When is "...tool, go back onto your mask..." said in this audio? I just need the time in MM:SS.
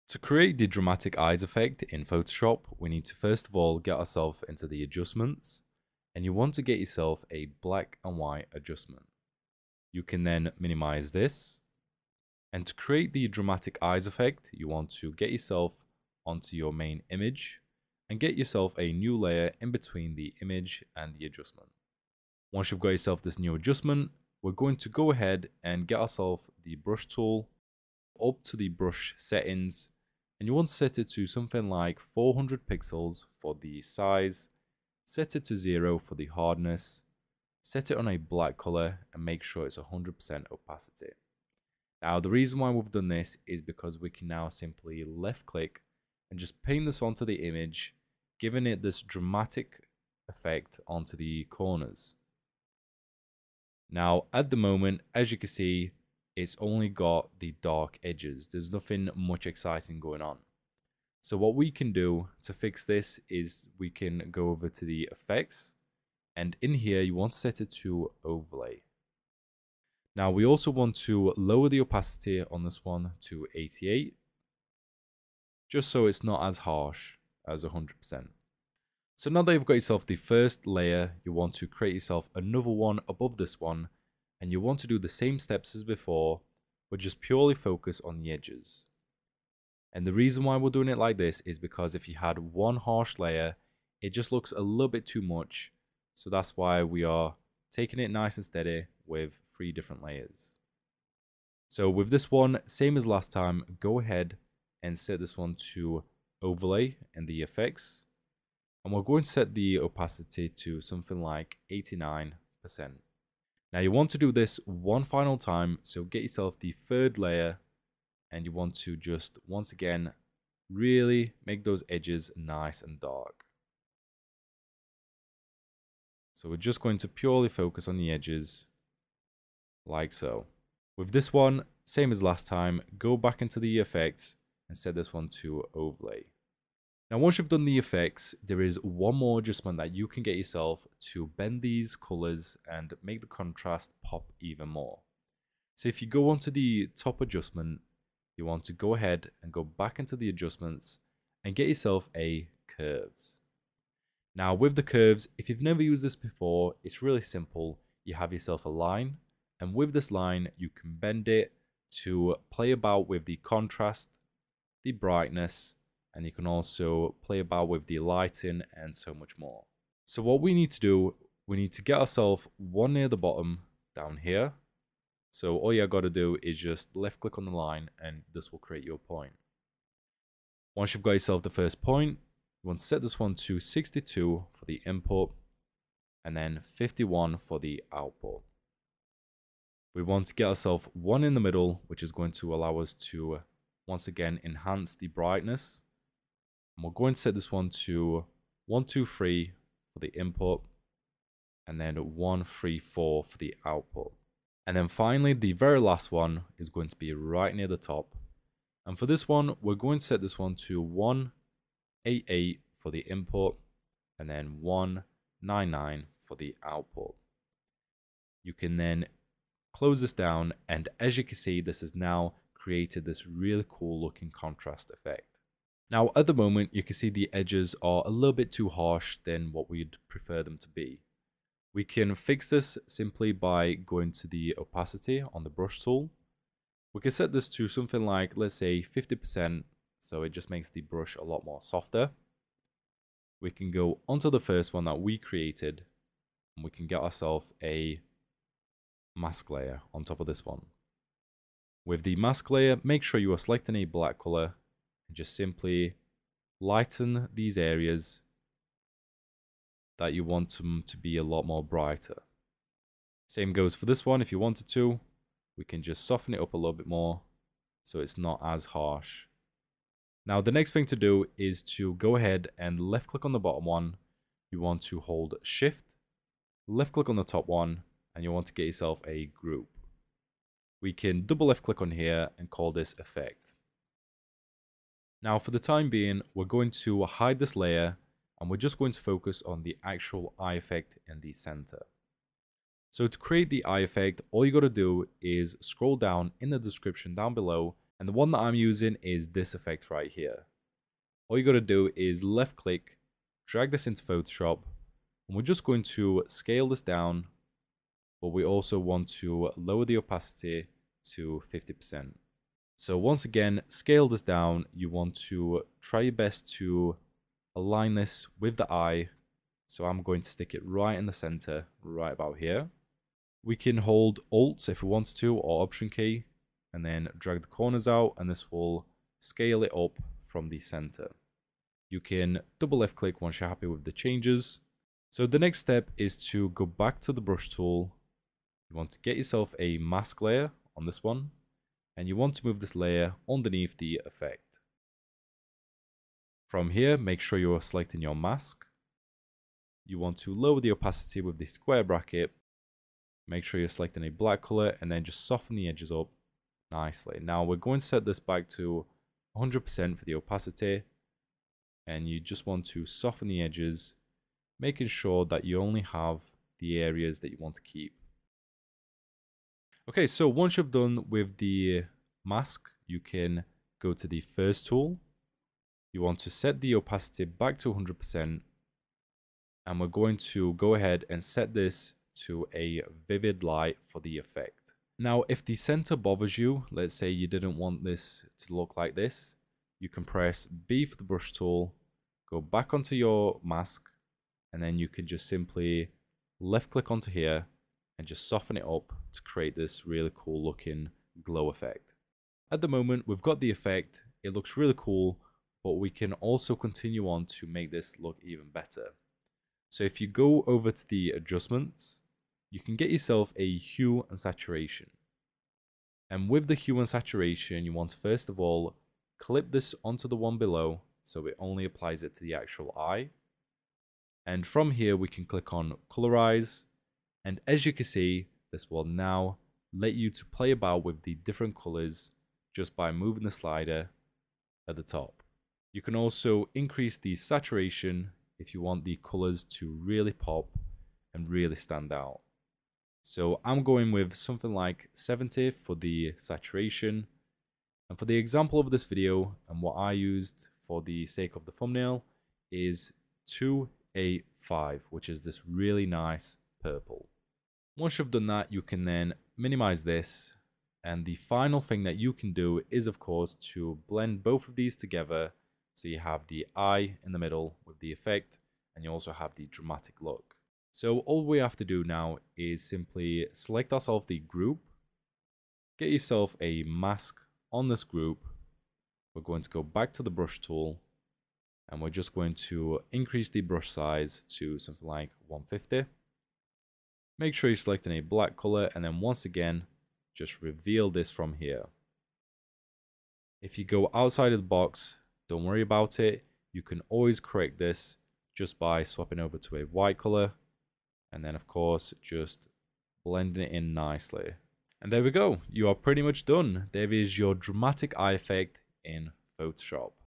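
06:31.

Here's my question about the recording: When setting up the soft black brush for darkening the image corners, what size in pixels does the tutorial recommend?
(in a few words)
400 pixels.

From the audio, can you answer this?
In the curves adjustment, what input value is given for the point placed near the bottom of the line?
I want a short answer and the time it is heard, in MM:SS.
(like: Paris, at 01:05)
62, at 03:03.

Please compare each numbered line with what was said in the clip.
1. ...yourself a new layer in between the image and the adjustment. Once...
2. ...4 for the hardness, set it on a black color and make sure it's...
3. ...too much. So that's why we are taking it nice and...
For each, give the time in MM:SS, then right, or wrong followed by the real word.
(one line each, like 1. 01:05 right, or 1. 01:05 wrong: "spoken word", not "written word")
1. 00:18 right
2. 00:35 wrong: "0", not "4"
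3. 01:35 right.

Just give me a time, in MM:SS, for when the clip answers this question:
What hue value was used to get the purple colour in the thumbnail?
07:33.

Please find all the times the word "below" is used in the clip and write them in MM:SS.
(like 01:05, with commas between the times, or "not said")
04:57, 07:00.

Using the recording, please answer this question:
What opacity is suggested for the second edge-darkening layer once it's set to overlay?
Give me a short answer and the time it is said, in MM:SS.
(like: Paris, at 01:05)
89%, at 01:51.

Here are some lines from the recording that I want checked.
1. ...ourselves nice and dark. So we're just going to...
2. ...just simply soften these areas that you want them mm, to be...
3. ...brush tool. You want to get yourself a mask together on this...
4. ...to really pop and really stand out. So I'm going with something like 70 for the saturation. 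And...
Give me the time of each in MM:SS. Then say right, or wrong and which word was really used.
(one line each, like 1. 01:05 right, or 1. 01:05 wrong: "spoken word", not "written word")
1. 02:01 wrong: "edges", not "ourselves"
2. 04:15 wrong: "lighten", not "soften"
3. 05:37 wrong: "layer", not "together"
4. 07:19 right.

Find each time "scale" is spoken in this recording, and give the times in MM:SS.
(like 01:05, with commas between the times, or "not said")
05:06, 05:13, 05:29.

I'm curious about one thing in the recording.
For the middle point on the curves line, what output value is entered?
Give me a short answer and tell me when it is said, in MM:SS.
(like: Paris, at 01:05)
134, at 03:21.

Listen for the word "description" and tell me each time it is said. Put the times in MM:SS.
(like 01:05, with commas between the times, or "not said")
04:56.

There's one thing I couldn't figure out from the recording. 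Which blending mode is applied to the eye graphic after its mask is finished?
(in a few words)
vivid light.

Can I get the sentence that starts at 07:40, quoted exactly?
And the final thing that you can do is, of course, to blend both of these together.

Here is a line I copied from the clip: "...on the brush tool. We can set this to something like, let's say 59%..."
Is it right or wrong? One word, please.
wrong.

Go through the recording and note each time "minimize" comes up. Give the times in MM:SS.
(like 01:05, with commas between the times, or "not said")
00:10, 07:39.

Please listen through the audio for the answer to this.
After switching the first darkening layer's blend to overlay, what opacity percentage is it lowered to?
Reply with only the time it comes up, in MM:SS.
01:13.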